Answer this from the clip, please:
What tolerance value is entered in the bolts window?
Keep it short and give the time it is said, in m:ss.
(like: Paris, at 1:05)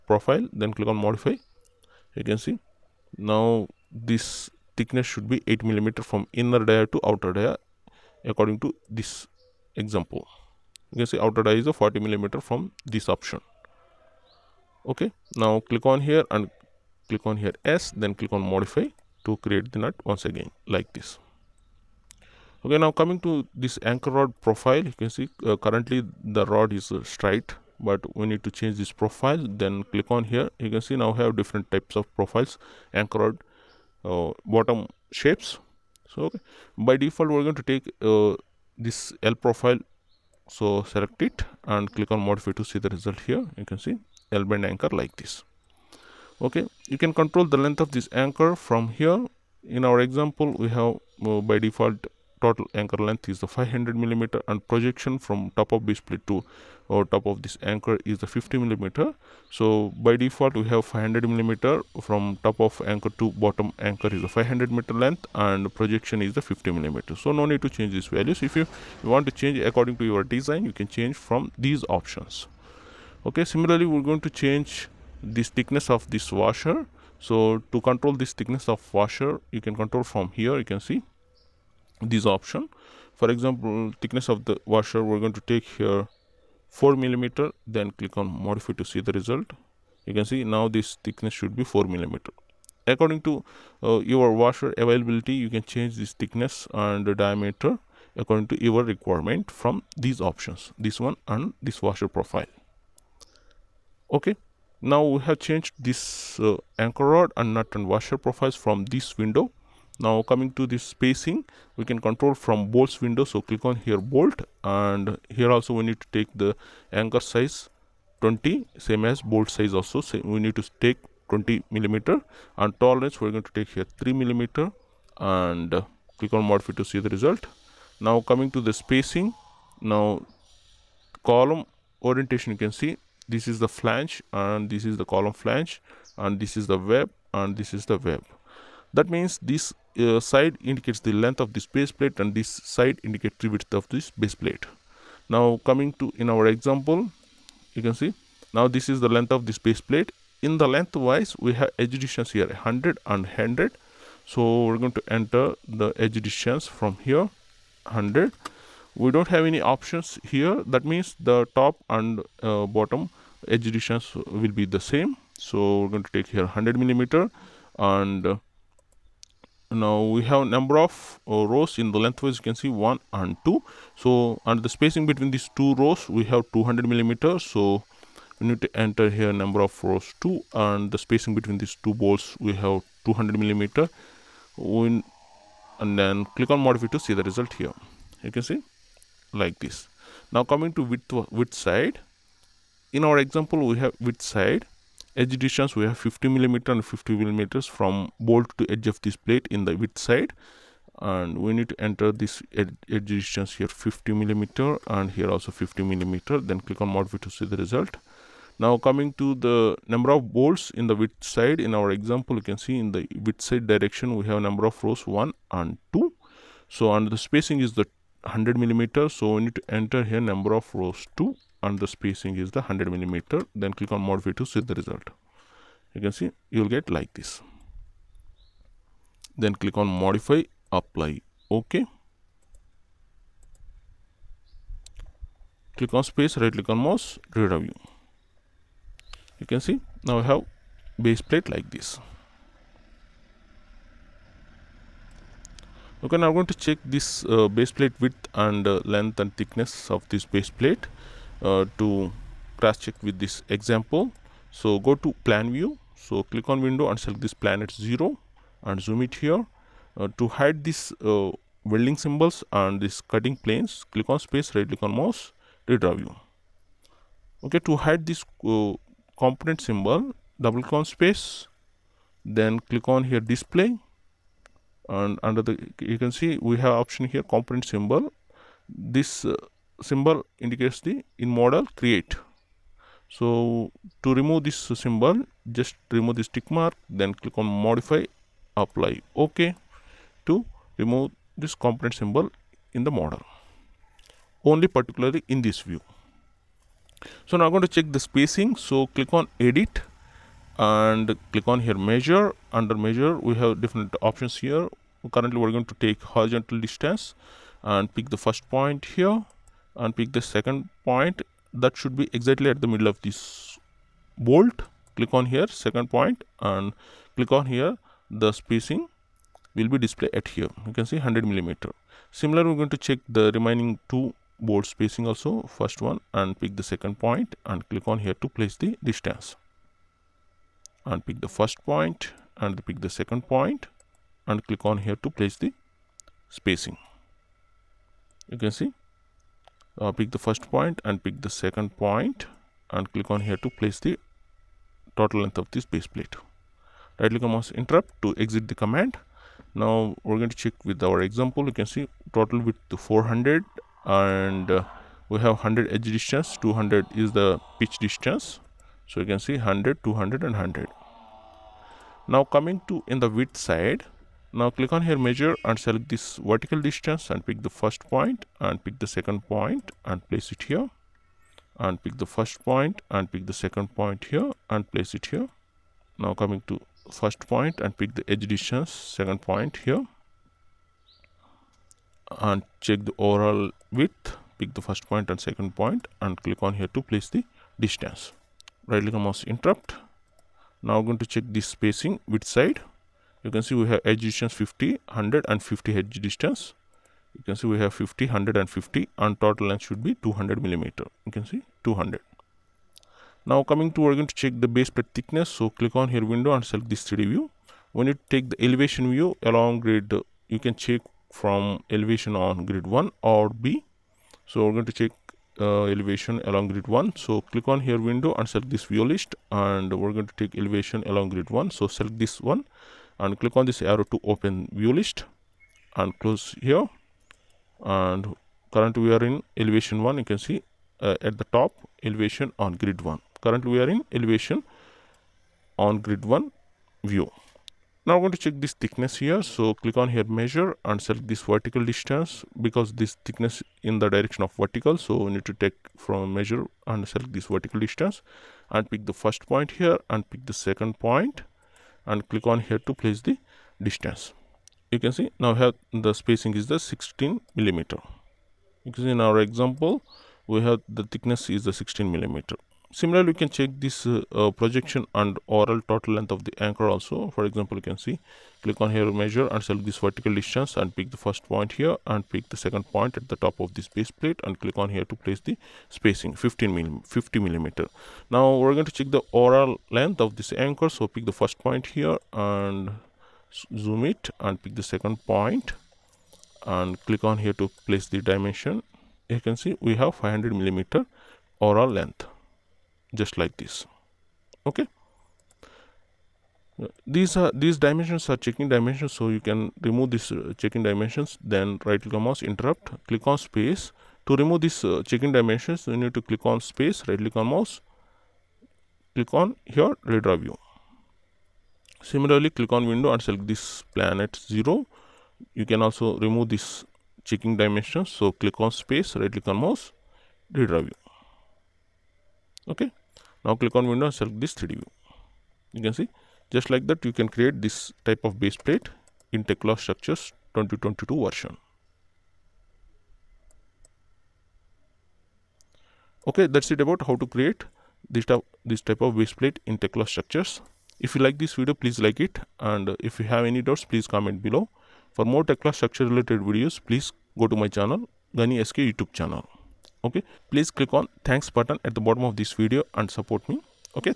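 3 mm, at 2:03.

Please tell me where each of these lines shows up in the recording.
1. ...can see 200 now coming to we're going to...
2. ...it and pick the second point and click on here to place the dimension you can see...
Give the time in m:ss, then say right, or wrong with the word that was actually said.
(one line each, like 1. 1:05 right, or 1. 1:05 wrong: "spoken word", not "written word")
1. 6:41 right
2. 8:03 right.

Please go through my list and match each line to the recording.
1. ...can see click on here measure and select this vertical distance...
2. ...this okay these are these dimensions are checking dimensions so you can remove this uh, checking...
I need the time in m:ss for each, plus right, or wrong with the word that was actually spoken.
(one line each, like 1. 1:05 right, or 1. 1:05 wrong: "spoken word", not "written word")
1. 7:47 right
2. 8:13 right.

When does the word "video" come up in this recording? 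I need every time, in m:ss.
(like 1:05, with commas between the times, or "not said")
9:01, 9:06, 9:12.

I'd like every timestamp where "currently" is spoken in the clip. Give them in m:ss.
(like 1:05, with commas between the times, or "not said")
0:25, 5:05, 7:08, 7:13.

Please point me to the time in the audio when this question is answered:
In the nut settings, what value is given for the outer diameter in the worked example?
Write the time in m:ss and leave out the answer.
0:11.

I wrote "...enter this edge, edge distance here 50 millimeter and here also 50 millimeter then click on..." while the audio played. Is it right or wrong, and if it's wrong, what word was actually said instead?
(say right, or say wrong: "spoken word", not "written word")
right.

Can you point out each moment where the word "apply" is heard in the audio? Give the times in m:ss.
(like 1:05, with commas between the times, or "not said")
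3:50, 4:48.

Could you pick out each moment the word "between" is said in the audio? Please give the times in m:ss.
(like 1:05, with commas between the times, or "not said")
2:55, 3:01.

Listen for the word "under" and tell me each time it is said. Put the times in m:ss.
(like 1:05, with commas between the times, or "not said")
4:35, 5:02.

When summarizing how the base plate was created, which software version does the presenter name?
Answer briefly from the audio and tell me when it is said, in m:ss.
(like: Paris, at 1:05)
2022, at 8:50.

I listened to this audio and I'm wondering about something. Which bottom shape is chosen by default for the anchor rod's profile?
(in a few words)
L profile.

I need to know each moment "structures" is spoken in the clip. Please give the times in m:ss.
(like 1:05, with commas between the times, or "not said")
8:49, 8:59, 9:05.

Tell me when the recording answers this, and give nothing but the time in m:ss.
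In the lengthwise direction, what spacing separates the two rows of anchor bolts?
2:56.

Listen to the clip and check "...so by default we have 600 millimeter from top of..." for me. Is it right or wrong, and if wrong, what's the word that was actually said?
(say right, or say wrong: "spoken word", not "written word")
wrong: "500", not "600".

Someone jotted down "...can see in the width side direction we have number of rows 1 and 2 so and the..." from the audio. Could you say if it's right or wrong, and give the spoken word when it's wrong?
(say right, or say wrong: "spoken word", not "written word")
right.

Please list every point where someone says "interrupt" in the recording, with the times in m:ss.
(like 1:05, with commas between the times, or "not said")
5:47, 6:29, 8:22.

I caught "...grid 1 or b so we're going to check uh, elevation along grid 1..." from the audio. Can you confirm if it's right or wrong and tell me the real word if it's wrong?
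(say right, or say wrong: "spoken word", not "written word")
right.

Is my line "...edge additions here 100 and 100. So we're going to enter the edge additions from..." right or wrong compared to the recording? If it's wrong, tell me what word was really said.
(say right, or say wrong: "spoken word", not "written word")
right.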